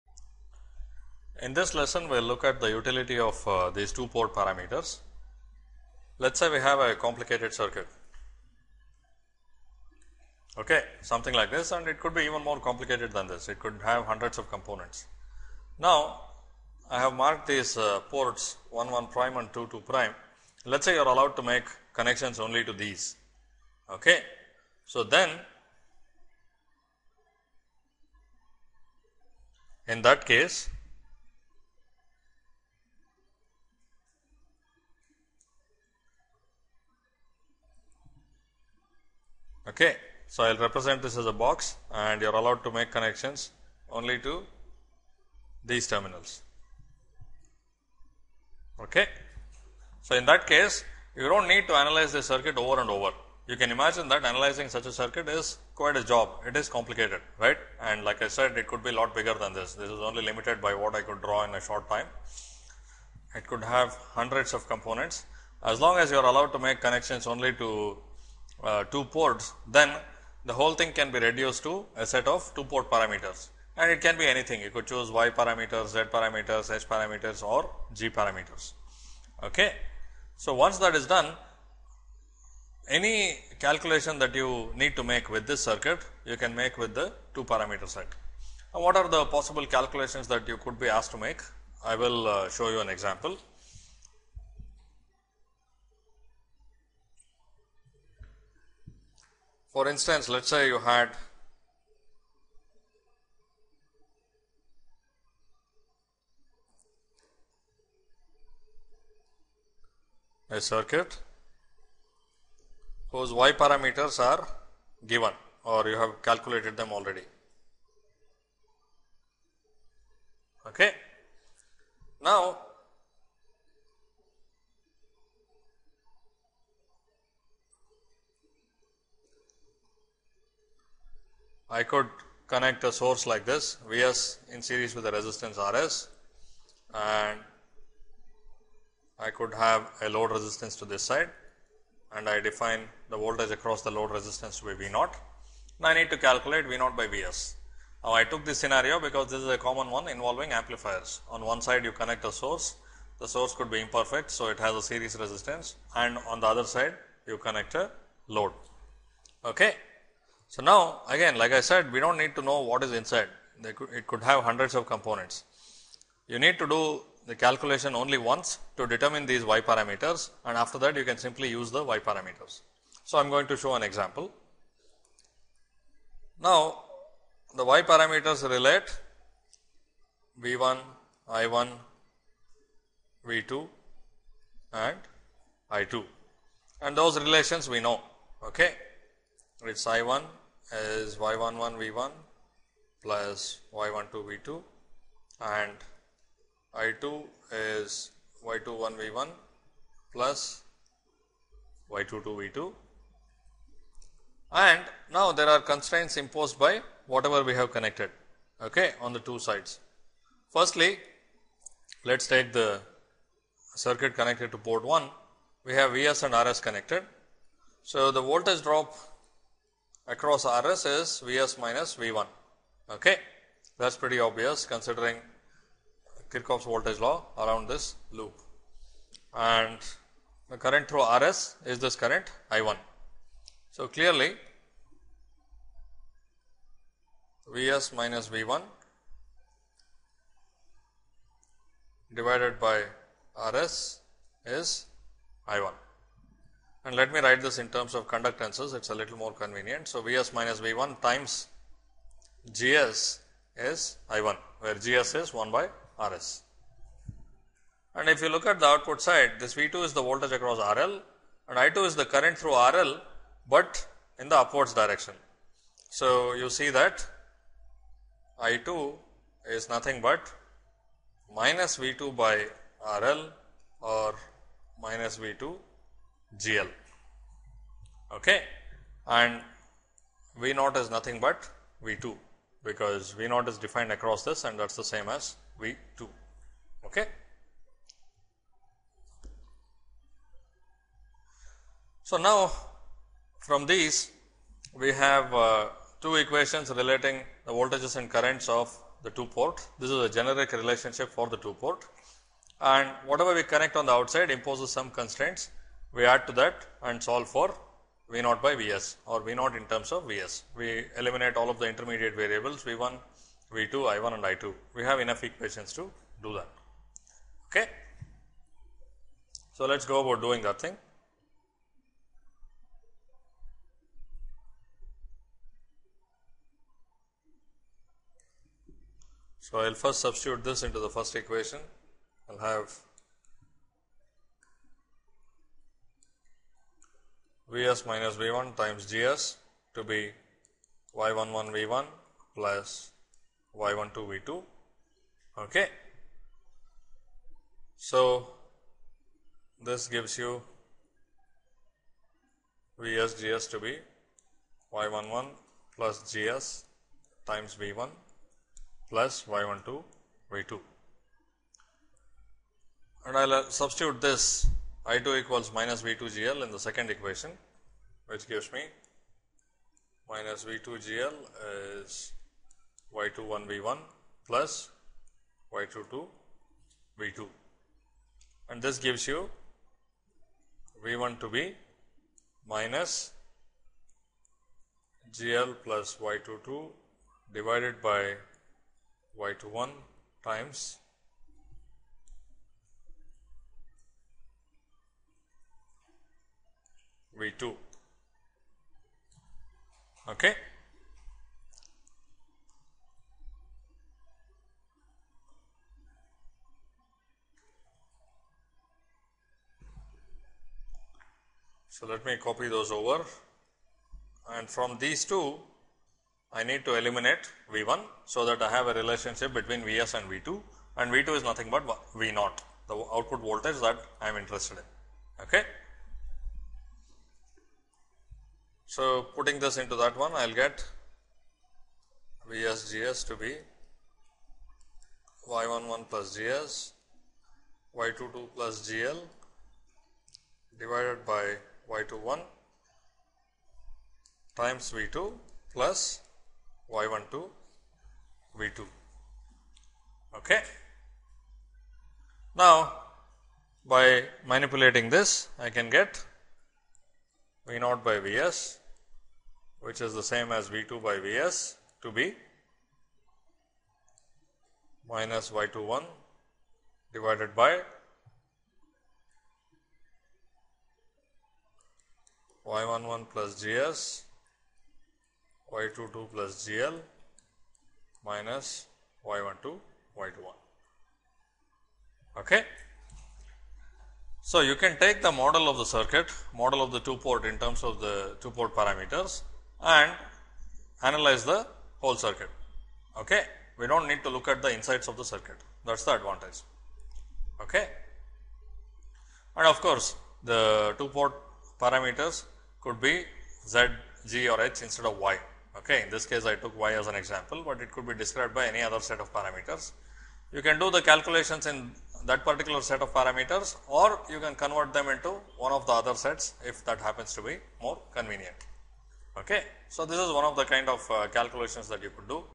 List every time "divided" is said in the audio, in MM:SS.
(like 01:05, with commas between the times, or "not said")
04:02, 06:27, 07:20, 07:46.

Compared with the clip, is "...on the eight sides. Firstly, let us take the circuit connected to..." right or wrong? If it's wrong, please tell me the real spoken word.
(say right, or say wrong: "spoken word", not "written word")
wrong: "two", not "eight".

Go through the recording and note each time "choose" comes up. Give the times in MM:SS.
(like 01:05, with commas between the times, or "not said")
01:14.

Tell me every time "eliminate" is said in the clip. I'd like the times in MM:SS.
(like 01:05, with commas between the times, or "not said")
05:10, 06:56.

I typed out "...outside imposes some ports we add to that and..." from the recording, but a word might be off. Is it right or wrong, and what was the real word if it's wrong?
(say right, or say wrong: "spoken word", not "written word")
wrong: "constraints", not "ports".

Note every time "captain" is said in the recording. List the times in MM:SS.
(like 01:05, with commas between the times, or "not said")
not said.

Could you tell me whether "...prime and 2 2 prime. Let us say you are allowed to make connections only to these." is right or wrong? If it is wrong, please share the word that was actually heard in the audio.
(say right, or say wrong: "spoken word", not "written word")
right.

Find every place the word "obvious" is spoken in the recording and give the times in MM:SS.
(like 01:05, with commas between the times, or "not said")
03:44.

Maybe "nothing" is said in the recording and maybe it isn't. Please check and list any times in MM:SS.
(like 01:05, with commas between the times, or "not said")
04:29, 04:40, 07:01.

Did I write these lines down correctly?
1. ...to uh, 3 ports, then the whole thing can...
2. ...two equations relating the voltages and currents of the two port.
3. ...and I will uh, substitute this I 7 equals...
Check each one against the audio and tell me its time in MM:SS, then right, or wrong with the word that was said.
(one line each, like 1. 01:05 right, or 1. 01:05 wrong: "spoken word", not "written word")
1. 01:07 wrong: "2", not "3"
2. 04:56 right
3. 06:03 wrong: "2", not "7".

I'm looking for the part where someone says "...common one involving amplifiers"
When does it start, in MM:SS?
02:29.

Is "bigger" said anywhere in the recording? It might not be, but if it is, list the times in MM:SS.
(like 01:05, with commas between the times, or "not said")
00:59.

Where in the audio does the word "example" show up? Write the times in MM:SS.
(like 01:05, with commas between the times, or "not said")
01:32, 02:53, 08:26.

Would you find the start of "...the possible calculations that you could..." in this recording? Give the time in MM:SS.
01:29.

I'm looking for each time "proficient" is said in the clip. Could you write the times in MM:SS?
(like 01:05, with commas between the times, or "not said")
not said.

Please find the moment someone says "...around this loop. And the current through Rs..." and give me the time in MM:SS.
03:47.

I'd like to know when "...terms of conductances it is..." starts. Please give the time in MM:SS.
04:07.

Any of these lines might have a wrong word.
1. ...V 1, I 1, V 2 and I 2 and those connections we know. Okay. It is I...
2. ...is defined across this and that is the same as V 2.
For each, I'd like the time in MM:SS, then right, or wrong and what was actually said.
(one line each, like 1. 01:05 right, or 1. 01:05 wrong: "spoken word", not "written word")
1. 03:00 wrong: "relations", not "connections"
2. 04:43 right.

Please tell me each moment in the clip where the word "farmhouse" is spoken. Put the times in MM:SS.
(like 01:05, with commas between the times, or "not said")
not said.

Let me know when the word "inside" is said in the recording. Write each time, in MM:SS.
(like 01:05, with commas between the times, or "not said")
02:42, 08:14.